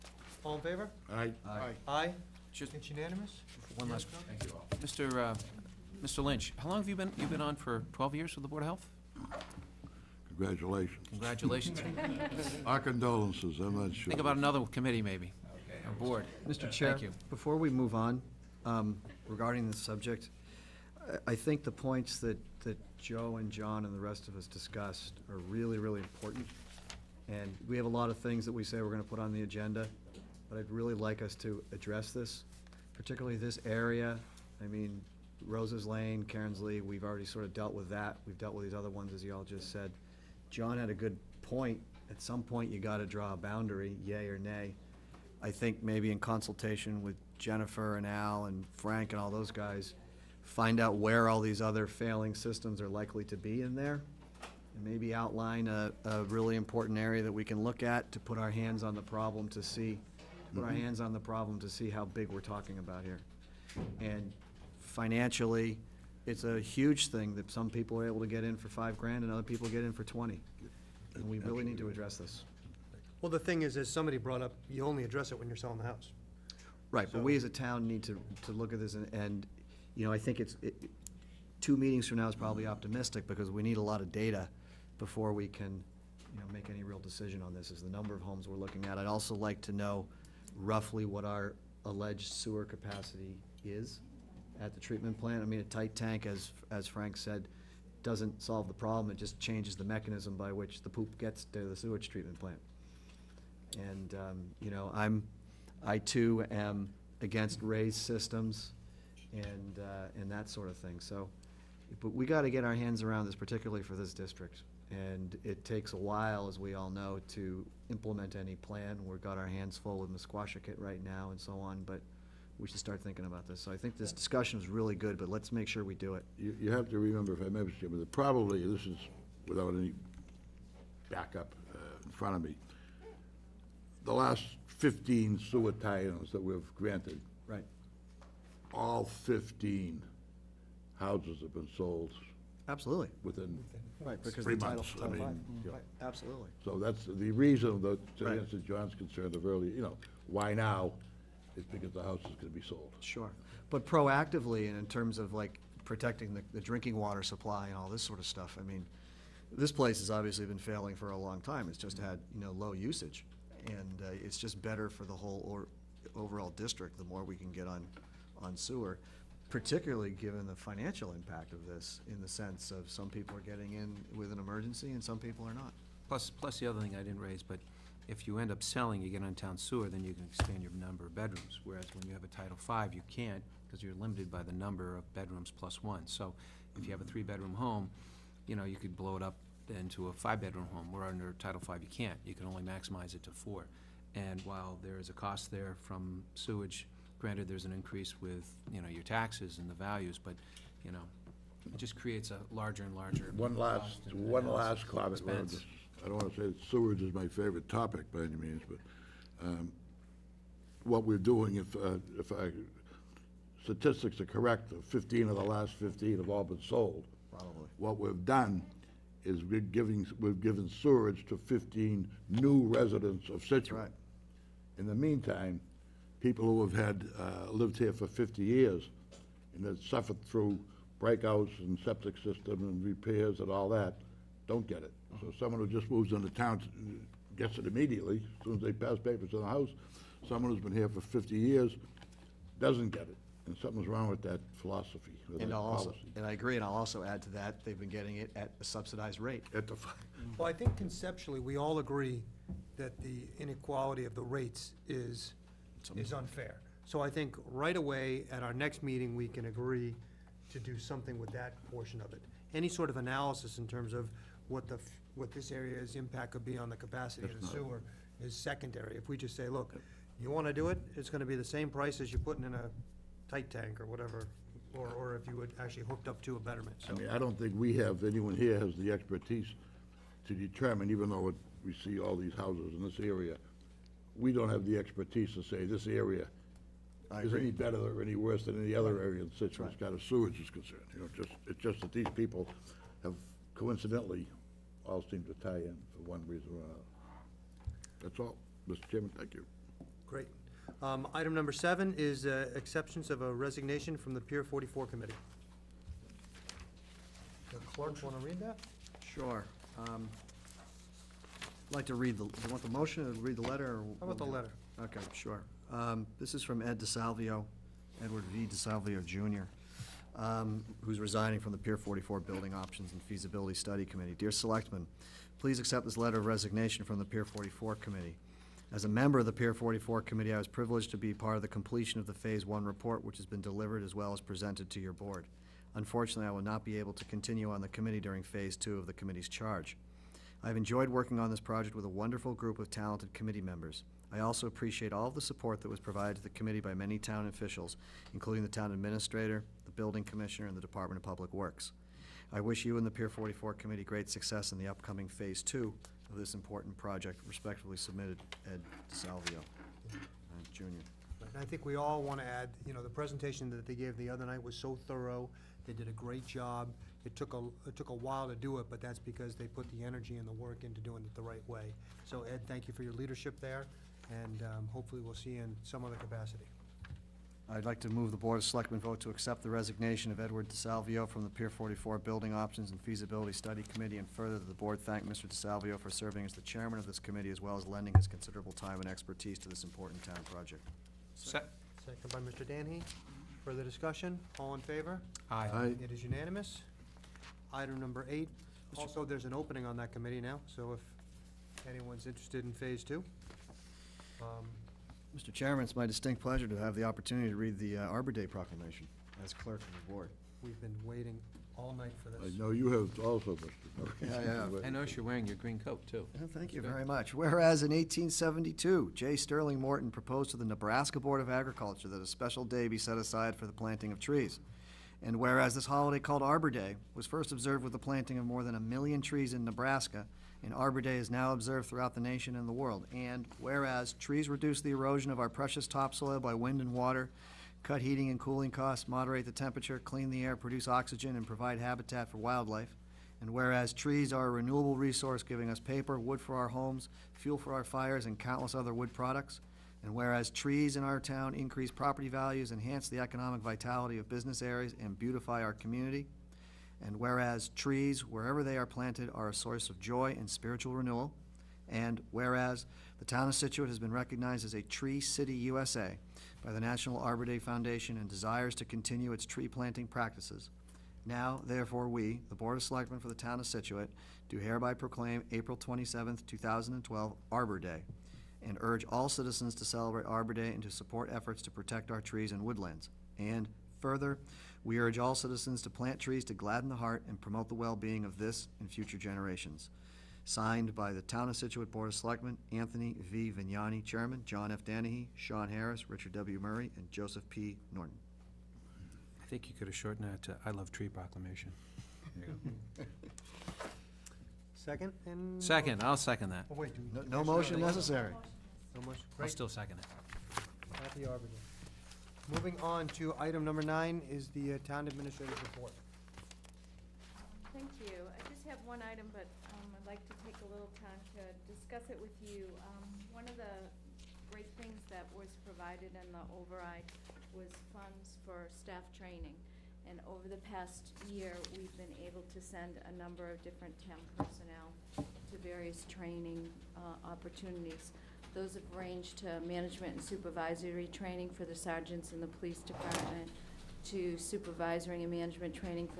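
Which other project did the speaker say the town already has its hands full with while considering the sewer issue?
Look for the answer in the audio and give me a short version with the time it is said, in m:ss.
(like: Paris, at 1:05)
Musquashcut, at 2:00.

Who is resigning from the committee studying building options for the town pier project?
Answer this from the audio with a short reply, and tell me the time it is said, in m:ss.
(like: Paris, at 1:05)
Edward V. DeSalvio Jr., at 5:18.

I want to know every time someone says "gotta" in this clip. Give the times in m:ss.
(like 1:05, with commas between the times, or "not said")
0:42, 1:52.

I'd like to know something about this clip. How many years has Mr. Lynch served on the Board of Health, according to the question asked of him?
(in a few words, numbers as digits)
12.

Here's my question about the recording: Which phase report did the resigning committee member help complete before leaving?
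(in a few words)
Phase 1.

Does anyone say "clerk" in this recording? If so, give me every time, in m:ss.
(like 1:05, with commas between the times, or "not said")
5:07, 6:49.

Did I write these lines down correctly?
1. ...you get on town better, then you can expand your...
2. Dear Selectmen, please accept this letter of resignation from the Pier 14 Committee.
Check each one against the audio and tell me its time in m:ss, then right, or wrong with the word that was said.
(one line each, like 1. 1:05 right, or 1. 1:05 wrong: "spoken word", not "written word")
1. 2:59 wrong: "sewer", not "better"
2. 5:24 wrong: "44", not "14".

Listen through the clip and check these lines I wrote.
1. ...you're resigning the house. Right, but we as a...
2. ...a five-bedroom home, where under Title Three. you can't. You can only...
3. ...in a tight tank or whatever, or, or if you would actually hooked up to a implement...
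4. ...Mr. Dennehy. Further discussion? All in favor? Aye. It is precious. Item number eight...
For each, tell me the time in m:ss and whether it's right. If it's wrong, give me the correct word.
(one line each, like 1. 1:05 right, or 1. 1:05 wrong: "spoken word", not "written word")
1. 1:15 wrong: "selling", not "resigning"
2. 3:10 wrong: "Five", not "Three"
3. 4:32 wrong: "betterment", not "implement"
4. 6:32 wrong: "unanimous", not "precious".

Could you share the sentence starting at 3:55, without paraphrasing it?
So someone who just moves into town gets it immediately, as soon as they pass papers to the house.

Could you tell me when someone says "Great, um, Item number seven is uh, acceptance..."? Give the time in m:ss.
5:00.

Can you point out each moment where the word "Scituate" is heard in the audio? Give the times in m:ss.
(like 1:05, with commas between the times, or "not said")
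3:43, 4:49, 7:43, 7:53, 8:11.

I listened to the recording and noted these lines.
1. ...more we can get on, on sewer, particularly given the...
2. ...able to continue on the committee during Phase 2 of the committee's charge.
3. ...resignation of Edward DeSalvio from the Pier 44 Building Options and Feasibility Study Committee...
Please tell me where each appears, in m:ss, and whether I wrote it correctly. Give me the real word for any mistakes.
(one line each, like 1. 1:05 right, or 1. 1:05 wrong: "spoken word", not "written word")
1. 2:47 right
2. 5:36 right
3. 6:19 right.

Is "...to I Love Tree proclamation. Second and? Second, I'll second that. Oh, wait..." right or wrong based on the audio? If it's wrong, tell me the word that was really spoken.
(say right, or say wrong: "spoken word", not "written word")
right.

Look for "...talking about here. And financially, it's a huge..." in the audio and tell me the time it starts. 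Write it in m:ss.
1:02.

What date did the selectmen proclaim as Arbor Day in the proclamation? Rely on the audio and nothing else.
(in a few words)
April 27, 2012.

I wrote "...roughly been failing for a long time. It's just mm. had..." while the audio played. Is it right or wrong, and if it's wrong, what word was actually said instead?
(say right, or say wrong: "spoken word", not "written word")
wrong: "obviously", not "roughly".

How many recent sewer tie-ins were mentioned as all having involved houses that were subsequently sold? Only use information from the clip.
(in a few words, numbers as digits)
15.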